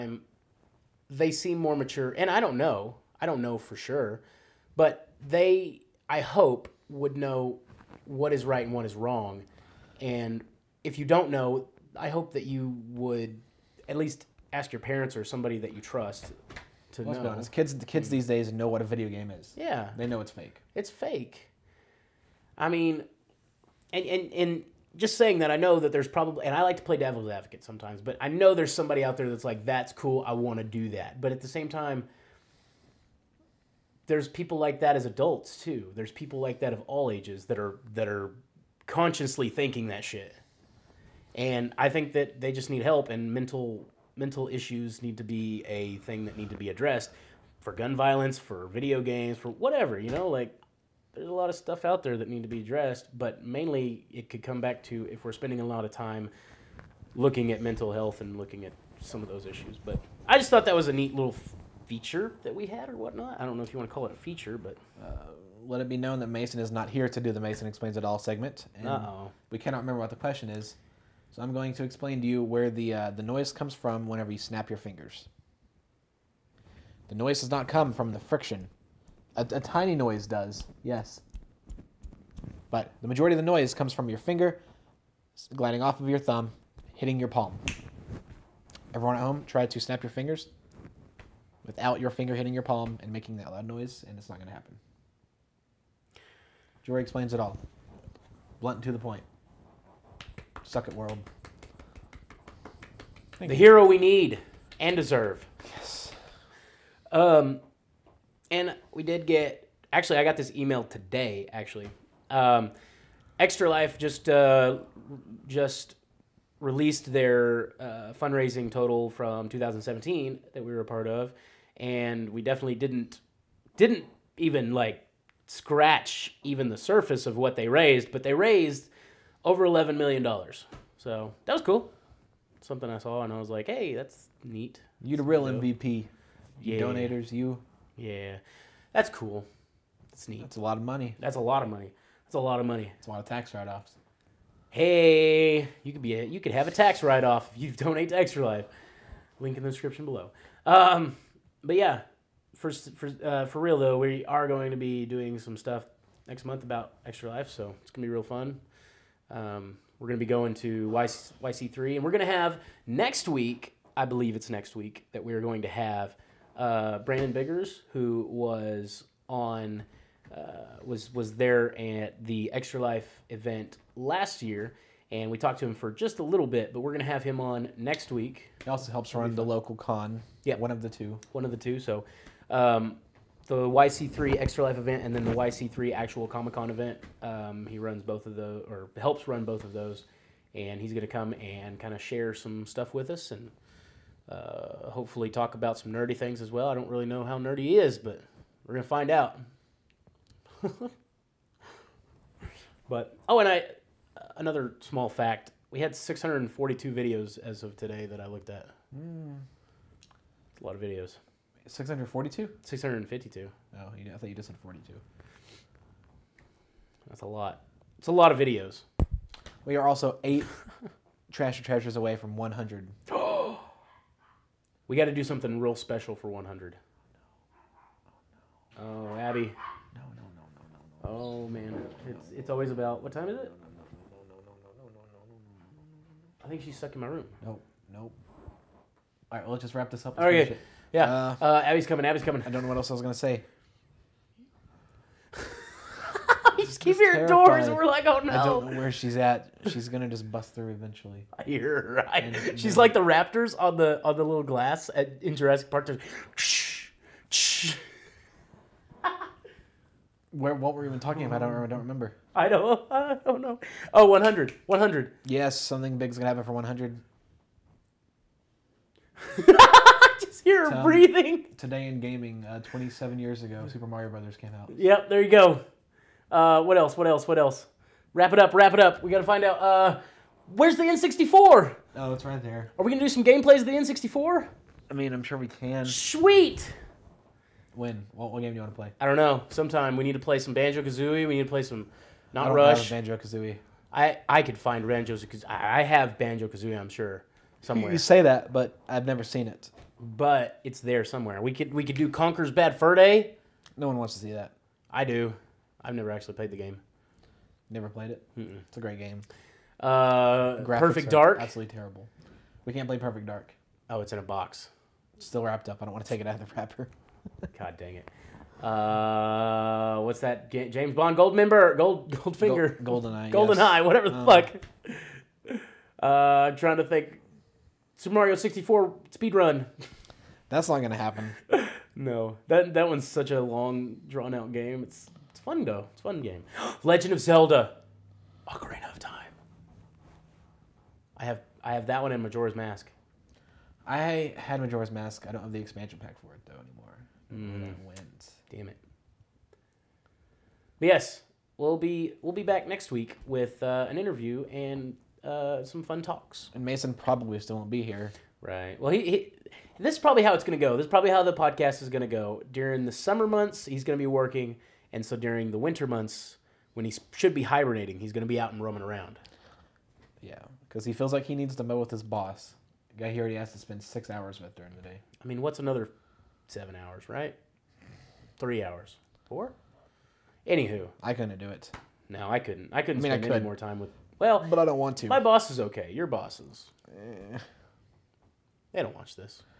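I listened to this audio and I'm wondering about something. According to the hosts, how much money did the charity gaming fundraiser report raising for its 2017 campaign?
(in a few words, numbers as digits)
over 11 million dollars.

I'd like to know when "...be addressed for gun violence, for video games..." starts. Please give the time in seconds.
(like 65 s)
46 s.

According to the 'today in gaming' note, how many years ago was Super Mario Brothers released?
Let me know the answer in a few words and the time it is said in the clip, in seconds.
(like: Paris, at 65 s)
27, at 272 s.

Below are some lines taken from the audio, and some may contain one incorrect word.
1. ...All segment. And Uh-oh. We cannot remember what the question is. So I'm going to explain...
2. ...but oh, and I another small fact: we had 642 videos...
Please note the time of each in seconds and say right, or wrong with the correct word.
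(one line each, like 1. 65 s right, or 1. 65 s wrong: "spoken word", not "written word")
1. 68 s right
2. 202 s right.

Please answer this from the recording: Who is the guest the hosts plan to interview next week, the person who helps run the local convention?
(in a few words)
Brandon Biggers.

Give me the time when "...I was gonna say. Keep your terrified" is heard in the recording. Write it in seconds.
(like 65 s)
242 s.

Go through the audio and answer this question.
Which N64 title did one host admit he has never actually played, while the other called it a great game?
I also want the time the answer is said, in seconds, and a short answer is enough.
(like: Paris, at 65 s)
Conker's Bad Fur Day, at 302 s.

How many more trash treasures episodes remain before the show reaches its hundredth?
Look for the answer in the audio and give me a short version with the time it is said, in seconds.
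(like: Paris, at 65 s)
8, at 220 s.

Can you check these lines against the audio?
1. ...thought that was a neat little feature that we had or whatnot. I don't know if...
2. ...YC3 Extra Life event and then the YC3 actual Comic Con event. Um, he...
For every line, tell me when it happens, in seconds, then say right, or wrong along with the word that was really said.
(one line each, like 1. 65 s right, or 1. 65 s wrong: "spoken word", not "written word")
1. 60 s right
2. 183 s right.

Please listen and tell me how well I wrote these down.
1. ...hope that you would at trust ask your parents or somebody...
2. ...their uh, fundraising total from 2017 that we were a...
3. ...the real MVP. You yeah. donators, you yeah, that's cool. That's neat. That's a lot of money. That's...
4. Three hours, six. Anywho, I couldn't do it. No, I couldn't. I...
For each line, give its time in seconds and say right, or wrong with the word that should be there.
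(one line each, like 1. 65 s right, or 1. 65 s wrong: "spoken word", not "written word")
1. 12 s wrong: "least", not "trust"
2. 117 s right
3. 135 s right
4. 378 s wrong: "four", not "six".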